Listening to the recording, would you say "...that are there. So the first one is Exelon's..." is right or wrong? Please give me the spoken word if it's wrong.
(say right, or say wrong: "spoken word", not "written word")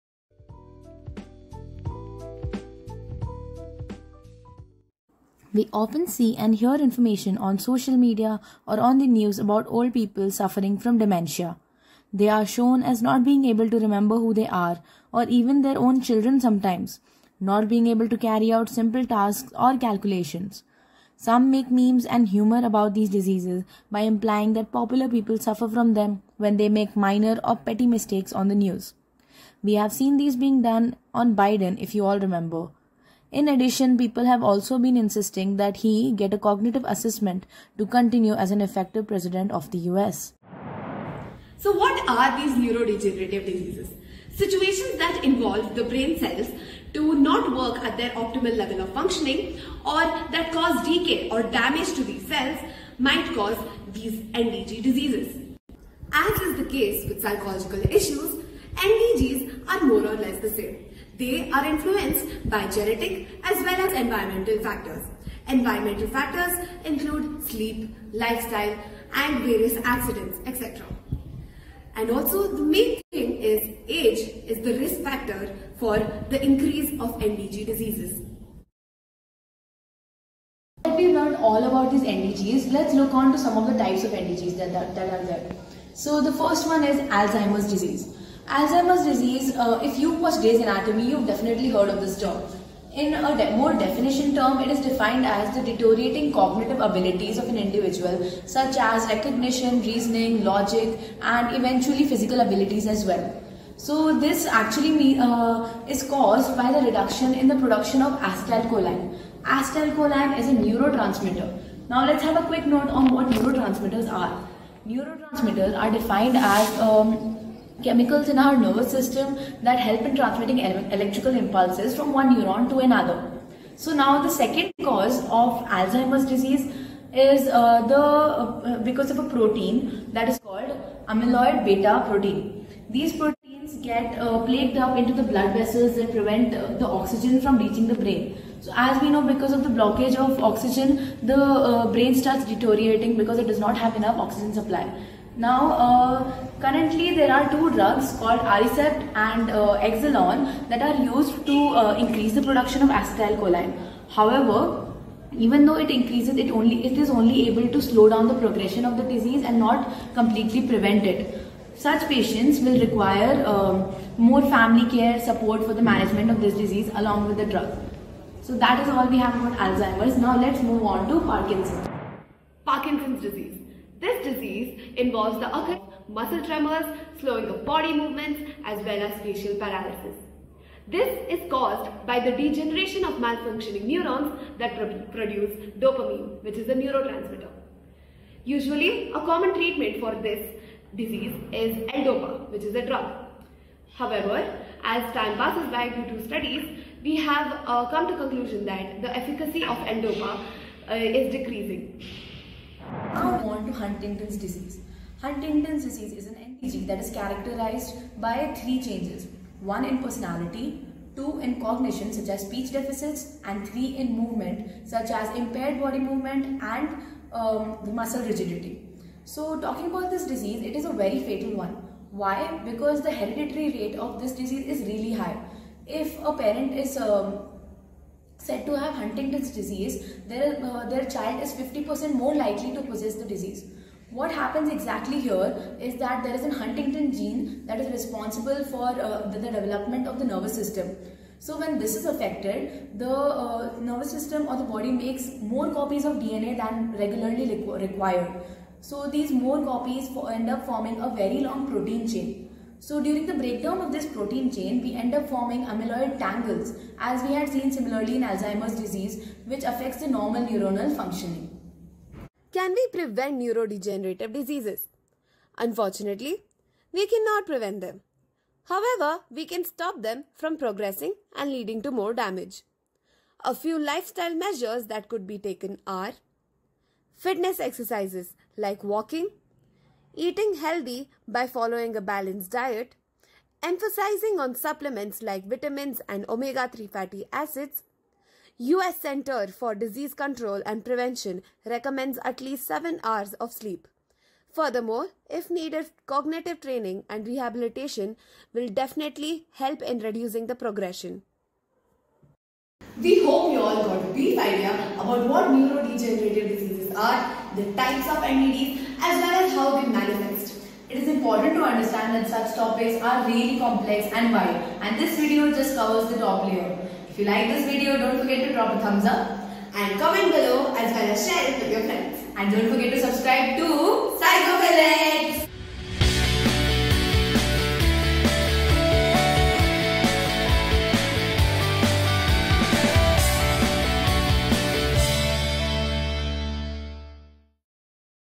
wrong: "Alzheimer", not "Exelon".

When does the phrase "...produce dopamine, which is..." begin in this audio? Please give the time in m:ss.
3:05.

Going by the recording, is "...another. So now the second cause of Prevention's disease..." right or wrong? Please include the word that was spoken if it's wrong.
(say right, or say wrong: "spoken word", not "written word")
wrong: "Alzheimer", not "Prevention".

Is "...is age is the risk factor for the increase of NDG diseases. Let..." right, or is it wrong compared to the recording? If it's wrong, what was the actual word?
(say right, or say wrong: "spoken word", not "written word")
right.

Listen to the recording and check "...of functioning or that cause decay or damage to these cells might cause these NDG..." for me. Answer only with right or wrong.
right.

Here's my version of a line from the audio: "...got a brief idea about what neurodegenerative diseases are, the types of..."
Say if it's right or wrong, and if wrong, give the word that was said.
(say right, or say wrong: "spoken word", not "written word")
right.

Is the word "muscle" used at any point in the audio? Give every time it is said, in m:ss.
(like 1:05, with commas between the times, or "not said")
2:56, 3:37.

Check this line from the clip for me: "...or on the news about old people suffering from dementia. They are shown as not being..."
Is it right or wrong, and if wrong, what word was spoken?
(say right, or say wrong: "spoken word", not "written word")
right.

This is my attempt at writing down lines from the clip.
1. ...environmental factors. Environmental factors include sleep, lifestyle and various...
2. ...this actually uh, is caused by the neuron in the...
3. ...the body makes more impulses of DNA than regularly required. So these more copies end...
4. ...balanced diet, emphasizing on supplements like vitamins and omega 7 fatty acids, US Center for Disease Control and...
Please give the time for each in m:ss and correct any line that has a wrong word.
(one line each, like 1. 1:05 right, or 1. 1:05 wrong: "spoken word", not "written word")
1. 1:03 right
2. 1:44 wrong: "reduction", not "neuron"
3. 4:04 wrong: "copies", not "impulses"
4. 4:42 wrong: "3", not "7".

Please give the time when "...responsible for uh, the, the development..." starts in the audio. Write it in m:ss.
3:57.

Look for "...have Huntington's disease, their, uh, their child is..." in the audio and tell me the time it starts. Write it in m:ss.
3:48.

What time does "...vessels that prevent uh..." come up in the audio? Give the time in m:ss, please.
2:15.